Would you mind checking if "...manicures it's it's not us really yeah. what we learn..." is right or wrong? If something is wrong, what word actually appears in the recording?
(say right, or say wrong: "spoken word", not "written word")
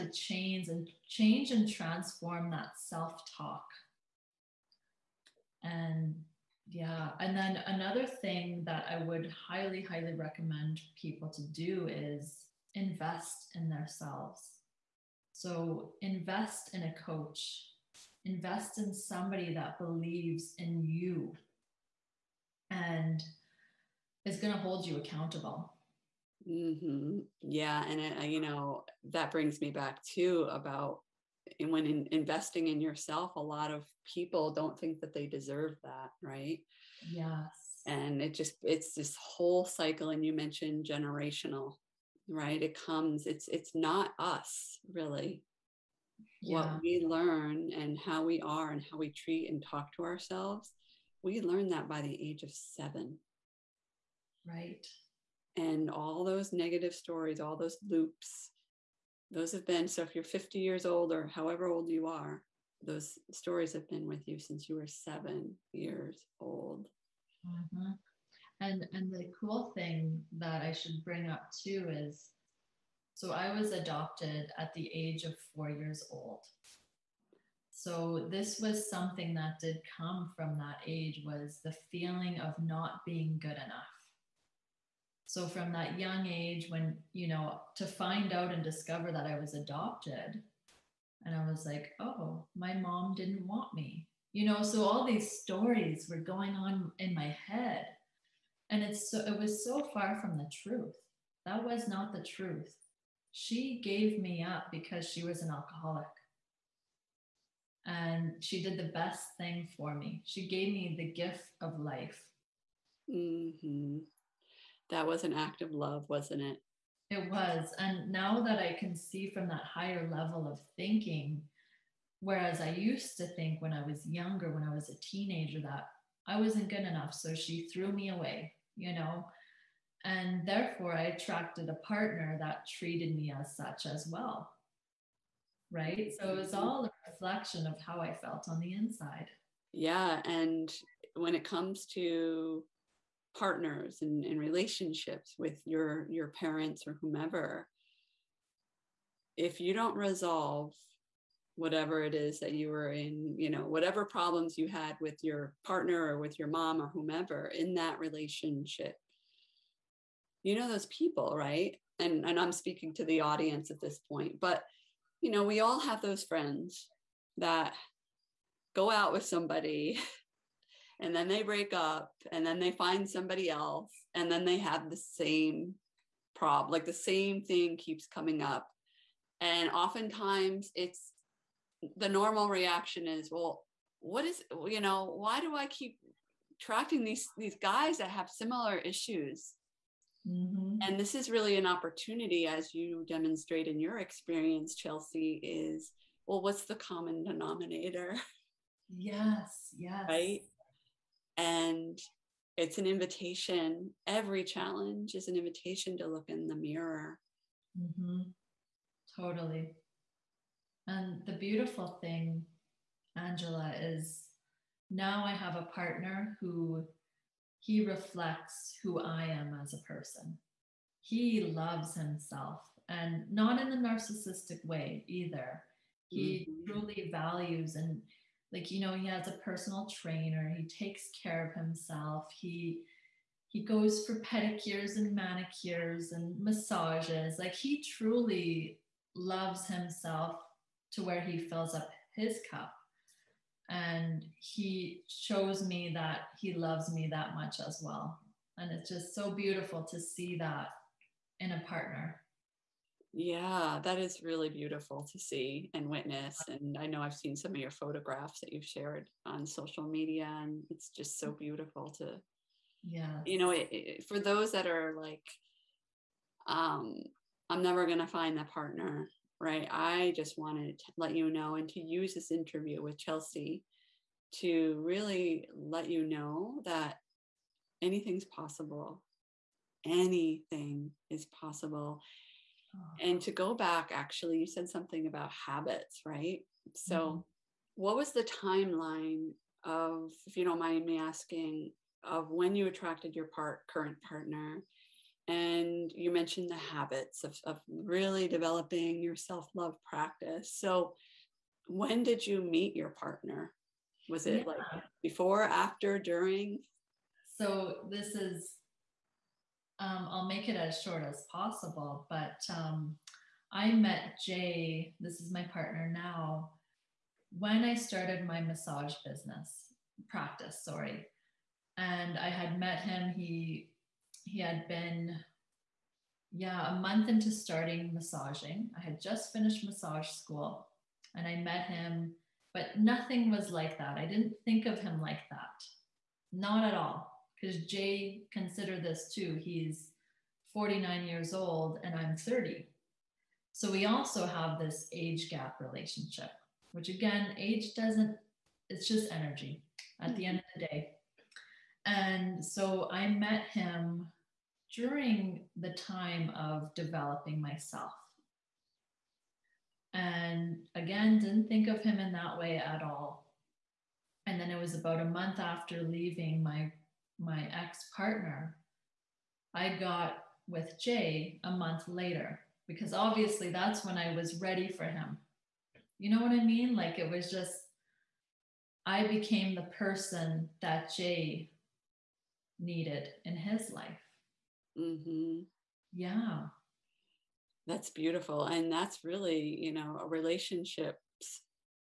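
wrong: "comes", not "manicures".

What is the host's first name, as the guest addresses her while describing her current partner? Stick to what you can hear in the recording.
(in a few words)
Angela.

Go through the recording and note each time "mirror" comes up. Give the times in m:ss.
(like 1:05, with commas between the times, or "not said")
3:26.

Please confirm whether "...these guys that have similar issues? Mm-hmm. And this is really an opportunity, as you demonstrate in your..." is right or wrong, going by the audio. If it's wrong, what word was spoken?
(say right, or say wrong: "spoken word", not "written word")
right.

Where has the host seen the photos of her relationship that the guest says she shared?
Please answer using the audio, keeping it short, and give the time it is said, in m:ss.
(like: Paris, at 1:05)
Social media, at 4:19.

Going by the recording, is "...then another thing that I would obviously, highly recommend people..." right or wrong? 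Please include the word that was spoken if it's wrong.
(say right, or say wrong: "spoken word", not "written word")
wrong: "highly", not "obviously".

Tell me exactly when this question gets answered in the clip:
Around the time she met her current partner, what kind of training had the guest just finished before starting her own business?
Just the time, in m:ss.
5:29.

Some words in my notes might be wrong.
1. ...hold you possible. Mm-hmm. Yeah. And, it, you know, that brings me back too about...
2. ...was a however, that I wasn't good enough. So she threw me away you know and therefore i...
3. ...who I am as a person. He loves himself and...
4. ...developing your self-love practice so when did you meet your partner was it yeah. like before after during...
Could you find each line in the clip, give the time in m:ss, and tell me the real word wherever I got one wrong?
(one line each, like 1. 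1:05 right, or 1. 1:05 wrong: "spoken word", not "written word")
1. 0:24 wrong: "accountable", not "possible"
2. 2:04 wrong: "teenager", not "however"
3. 3:38 right
4. 4:58 right.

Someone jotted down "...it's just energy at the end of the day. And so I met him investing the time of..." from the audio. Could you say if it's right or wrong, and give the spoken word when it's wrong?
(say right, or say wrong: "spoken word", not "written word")
wrong: "during", not "investing".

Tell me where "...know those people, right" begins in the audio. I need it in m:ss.
2:40.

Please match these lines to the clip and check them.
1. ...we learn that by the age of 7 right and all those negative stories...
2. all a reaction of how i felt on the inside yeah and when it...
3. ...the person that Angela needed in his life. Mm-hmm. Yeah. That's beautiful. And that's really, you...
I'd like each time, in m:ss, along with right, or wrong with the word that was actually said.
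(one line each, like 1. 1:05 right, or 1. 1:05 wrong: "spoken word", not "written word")
1. 0:51 right
2. 2:16 wrong: "reflection", not "reaction"
3. 6:19 wrong: "Jay", not "Angela".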